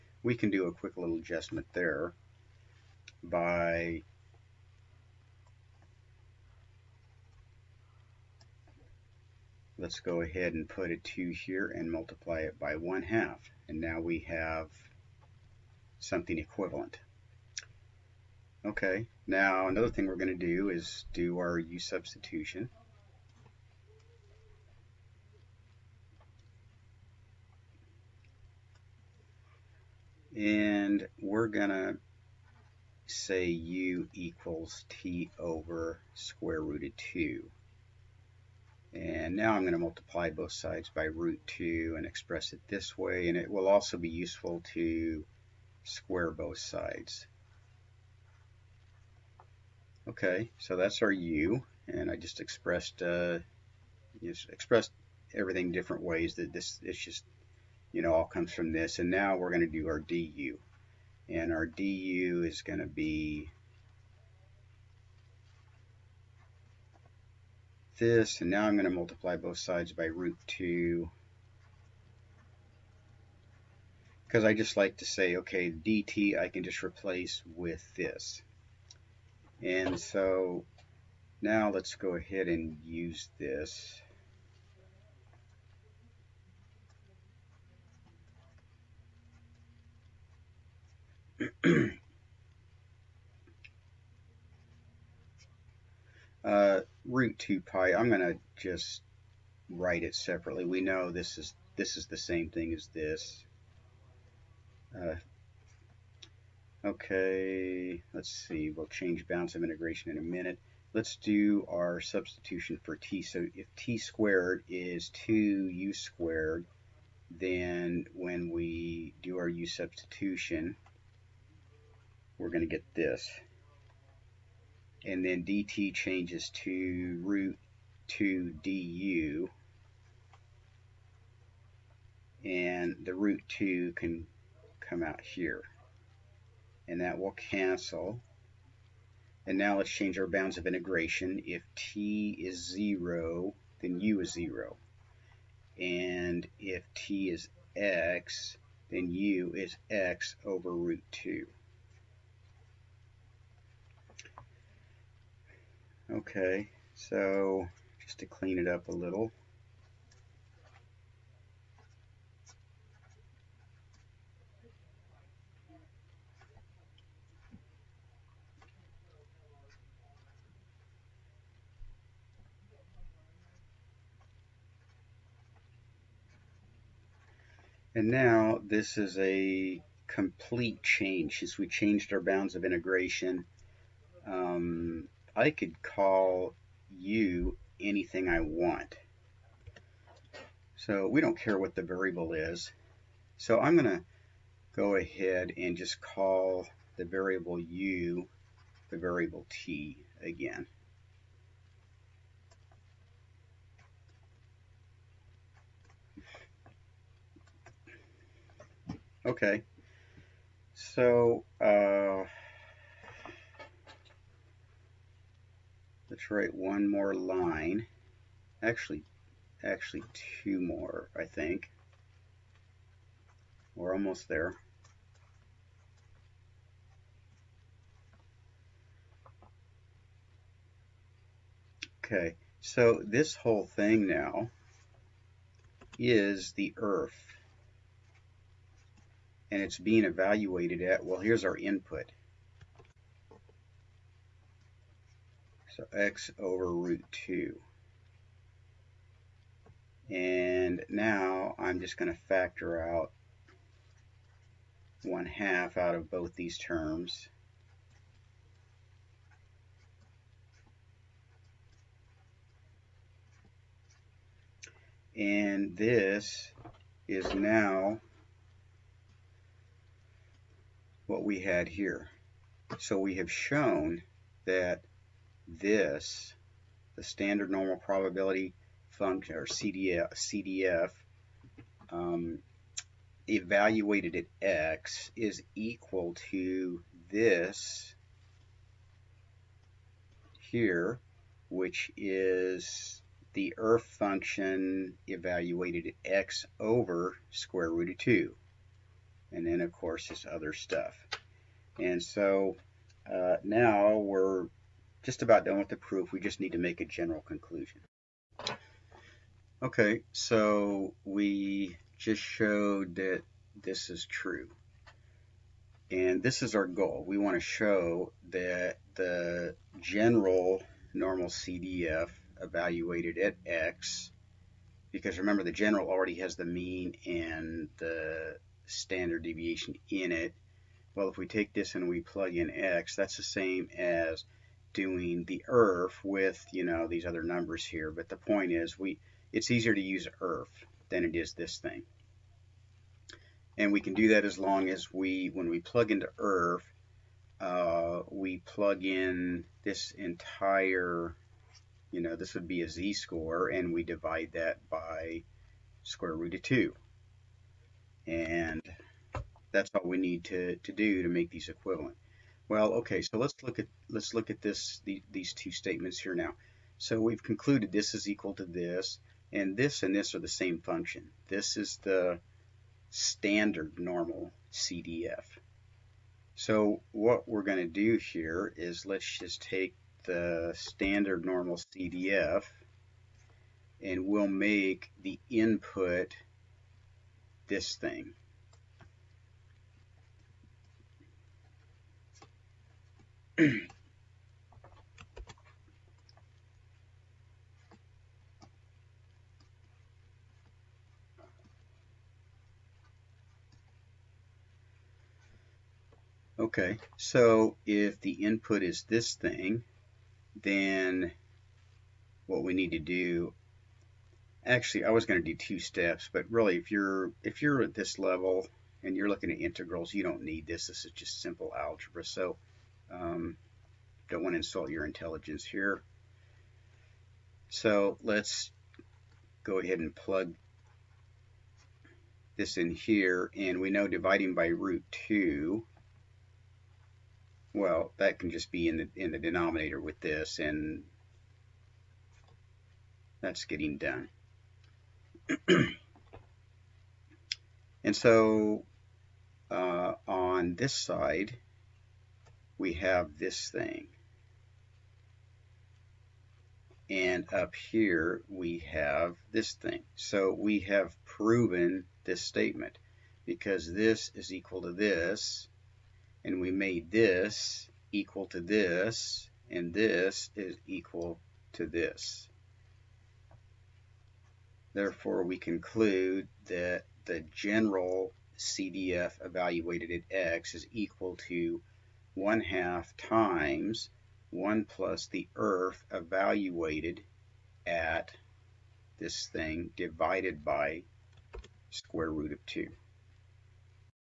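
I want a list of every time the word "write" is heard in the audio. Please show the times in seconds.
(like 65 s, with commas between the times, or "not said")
99 s, 216 s.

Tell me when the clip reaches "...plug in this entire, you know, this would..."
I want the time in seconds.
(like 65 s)
348 s.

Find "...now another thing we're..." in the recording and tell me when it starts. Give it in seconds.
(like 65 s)
19 s.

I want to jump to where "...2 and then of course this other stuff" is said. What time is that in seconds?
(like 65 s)
297 s.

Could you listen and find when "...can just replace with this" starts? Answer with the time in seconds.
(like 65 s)
76 s.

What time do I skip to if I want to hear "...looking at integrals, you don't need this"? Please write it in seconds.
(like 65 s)
419 s.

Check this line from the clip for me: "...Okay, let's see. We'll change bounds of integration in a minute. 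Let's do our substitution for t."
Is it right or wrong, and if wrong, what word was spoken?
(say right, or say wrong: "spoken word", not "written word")
right.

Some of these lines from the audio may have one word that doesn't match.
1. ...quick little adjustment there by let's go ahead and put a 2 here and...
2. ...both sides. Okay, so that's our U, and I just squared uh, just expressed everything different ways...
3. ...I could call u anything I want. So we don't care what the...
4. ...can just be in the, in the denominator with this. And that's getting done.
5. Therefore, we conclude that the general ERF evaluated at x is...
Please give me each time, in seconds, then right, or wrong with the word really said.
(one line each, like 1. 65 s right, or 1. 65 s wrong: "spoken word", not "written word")
1. 0 s right
2. 46 s wrong: "expressed", not "squared"
3. 185 s right
4. 438 s right
5. 474 s wrong: "CDF", not "ERF".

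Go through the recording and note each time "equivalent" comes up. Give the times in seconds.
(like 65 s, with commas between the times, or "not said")
16 s, 361 s.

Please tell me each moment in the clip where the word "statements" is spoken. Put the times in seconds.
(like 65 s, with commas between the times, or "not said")
365 s, 462 s.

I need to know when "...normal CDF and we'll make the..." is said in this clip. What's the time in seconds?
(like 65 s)
381 s.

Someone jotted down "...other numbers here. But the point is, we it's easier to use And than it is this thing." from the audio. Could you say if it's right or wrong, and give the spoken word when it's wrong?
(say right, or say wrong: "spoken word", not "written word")
wrong: "ERF", not "And".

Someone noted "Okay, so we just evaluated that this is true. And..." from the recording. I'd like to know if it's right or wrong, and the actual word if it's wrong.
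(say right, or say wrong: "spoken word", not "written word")
wrong: "showed", not "evaluated".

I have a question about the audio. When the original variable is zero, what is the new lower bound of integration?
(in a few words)
0.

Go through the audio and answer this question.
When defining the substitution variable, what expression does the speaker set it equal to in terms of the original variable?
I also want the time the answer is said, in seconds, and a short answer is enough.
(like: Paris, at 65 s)
t over square root of 2, at 34 s.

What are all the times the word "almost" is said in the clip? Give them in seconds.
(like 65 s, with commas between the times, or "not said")
223 s.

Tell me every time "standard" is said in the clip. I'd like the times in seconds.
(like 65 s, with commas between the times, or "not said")
277 s, 328 s, 372 s, 380 s.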